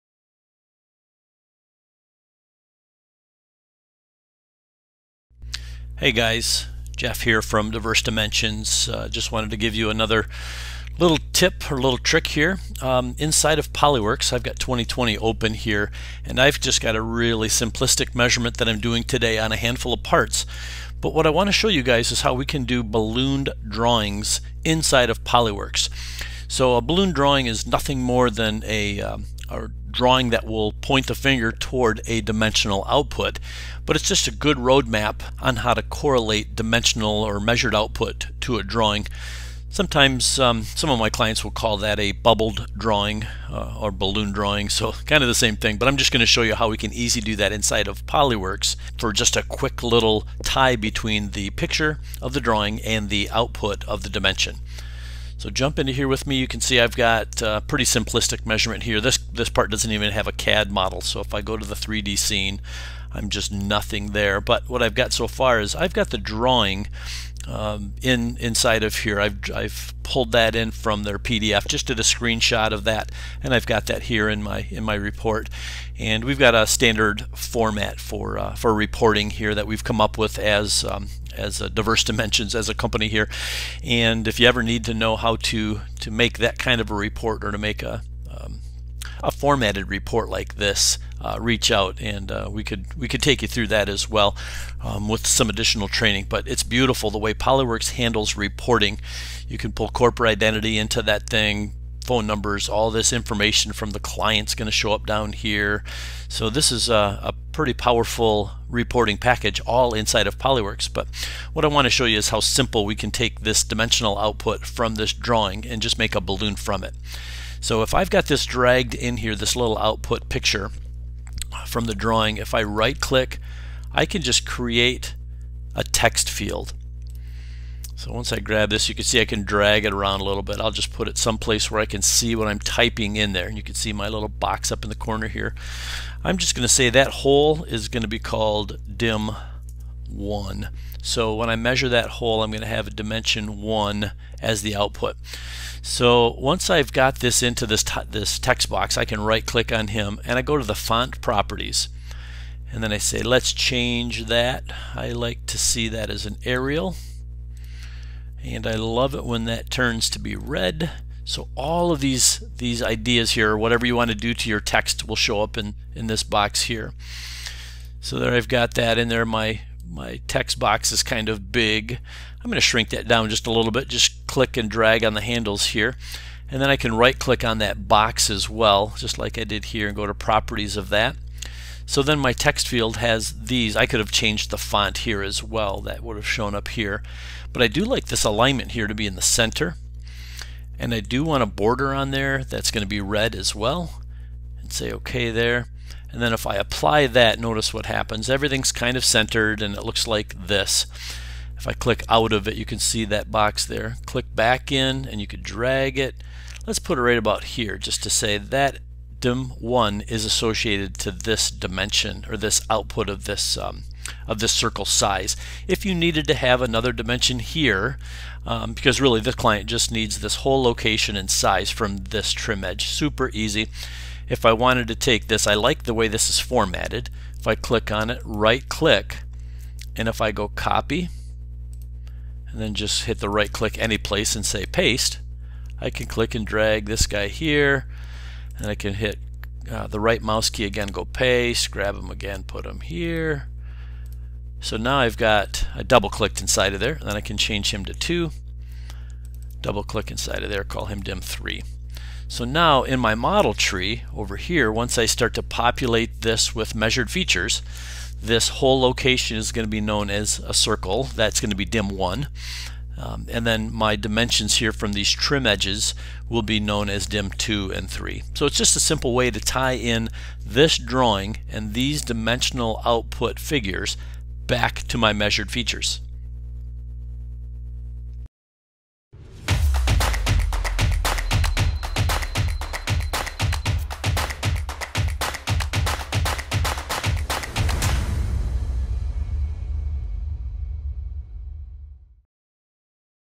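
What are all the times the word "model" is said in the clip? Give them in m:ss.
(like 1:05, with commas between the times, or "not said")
1:00, 4:13.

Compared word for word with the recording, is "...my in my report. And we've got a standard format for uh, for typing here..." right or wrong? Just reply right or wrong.
wrong.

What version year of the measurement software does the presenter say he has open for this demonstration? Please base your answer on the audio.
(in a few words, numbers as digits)
2020.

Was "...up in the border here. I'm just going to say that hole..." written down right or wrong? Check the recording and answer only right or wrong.
wrong.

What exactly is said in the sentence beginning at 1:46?
So this is a, a, pretty powerful reporting package all inside of Polyworks.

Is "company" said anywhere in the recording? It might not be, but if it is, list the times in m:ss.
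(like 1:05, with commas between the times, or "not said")
1:22.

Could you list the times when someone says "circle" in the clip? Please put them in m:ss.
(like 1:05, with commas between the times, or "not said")
3:34, 4:20.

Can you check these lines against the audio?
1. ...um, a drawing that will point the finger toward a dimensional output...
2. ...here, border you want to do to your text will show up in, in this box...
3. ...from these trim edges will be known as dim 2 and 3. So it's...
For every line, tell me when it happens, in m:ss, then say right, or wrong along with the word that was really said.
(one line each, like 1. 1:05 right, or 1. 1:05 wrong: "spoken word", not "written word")
1. 0:29 right
2. 2:43 wrong: "whatever", not "border"
3. 4:24 right.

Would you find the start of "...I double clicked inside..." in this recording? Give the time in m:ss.
4:05.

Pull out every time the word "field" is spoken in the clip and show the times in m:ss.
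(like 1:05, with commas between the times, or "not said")
2:06, 3:02.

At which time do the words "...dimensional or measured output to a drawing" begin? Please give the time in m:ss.
0:36.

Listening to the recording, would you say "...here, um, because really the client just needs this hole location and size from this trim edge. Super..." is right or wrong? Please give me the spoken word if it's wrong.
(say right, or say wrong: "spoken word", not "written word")
right.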